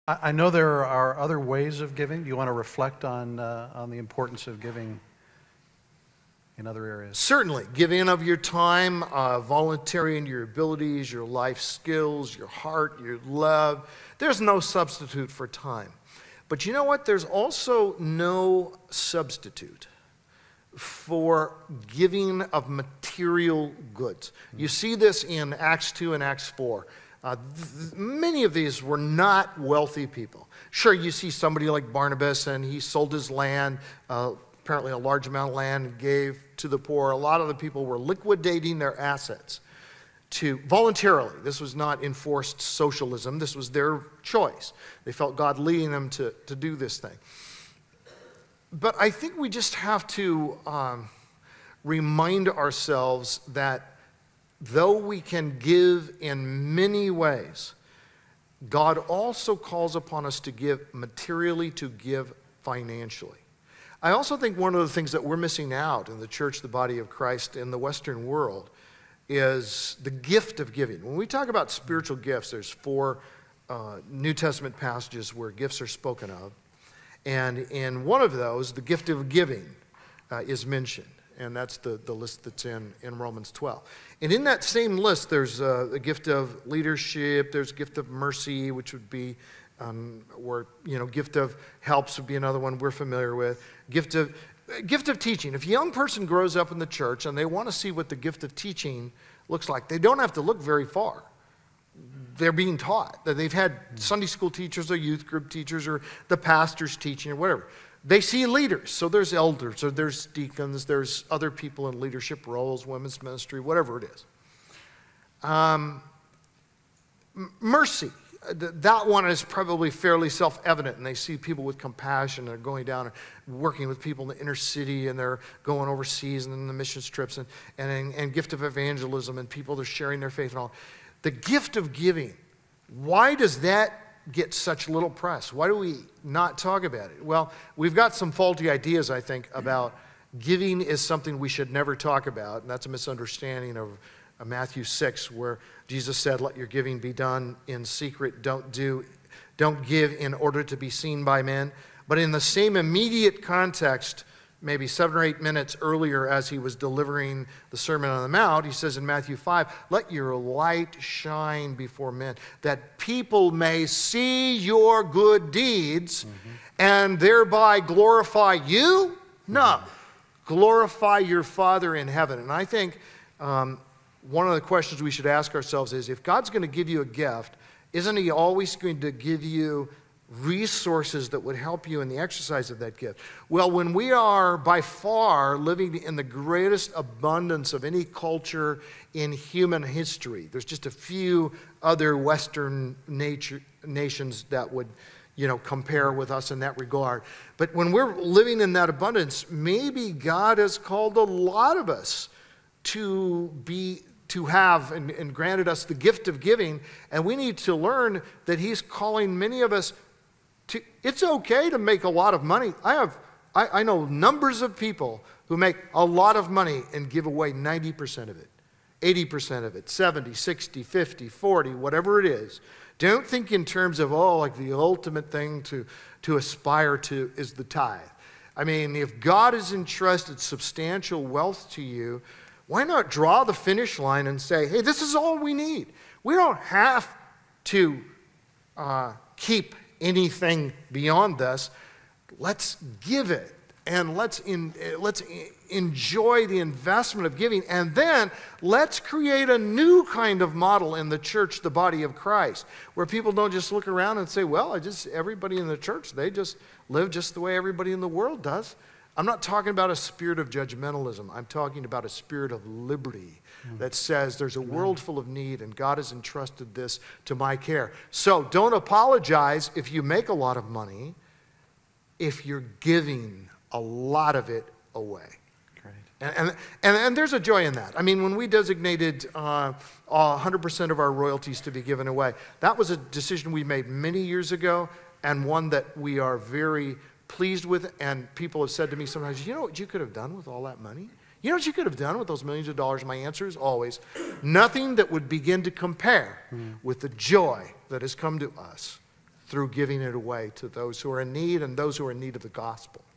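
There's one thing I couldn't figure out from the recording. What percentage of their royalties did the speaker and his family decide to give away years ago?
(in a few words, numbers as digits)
100%.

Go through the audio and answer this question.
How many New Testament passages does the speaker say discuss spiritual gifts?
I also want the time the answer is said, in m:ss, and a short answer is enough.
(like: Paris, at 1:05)
4, at 1:12.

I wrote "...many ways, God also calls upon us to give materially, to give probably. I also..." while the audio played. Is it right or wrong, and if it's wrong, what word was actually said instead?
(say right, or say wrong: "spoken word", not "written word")
wrong: "financially", not "probably".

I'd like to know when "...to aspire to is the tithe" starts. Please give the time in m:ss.
3:46.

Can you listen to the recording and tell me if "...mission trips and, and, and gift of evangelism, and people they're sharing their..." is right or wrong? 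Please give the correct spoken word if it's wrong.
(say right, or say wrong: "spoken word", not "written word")
right.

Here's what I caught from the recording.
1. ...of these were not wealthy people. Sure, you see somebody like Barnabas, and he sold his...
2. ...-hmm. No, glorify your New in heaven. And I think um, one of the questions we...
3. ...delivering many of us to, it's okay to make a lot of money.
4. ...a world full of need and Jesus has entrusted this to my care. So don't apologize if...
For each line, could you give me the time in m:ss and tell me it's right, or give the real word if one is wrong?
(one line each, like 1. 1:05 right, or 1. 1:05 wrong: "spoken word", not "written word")
1. 0:28 right
2. 2:49 wrong: "Father", not "New"
3. 3:28 wrong: "calling", not "delivering"
4. 4:24 wrong: "God", not "Jesus".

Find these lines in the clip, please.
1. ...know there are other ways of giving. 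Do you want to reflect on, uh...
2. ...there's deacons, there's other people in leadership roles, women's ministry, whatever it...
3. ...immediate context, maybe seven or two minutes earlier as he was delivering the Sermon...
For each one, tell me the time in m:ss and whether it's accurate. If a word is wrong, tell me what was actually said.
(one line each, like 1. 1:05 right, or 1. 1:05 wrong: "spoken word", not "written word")
1. 0:00 right
2. 1:49 right
3. 2:32 wrong: "eight", not "two".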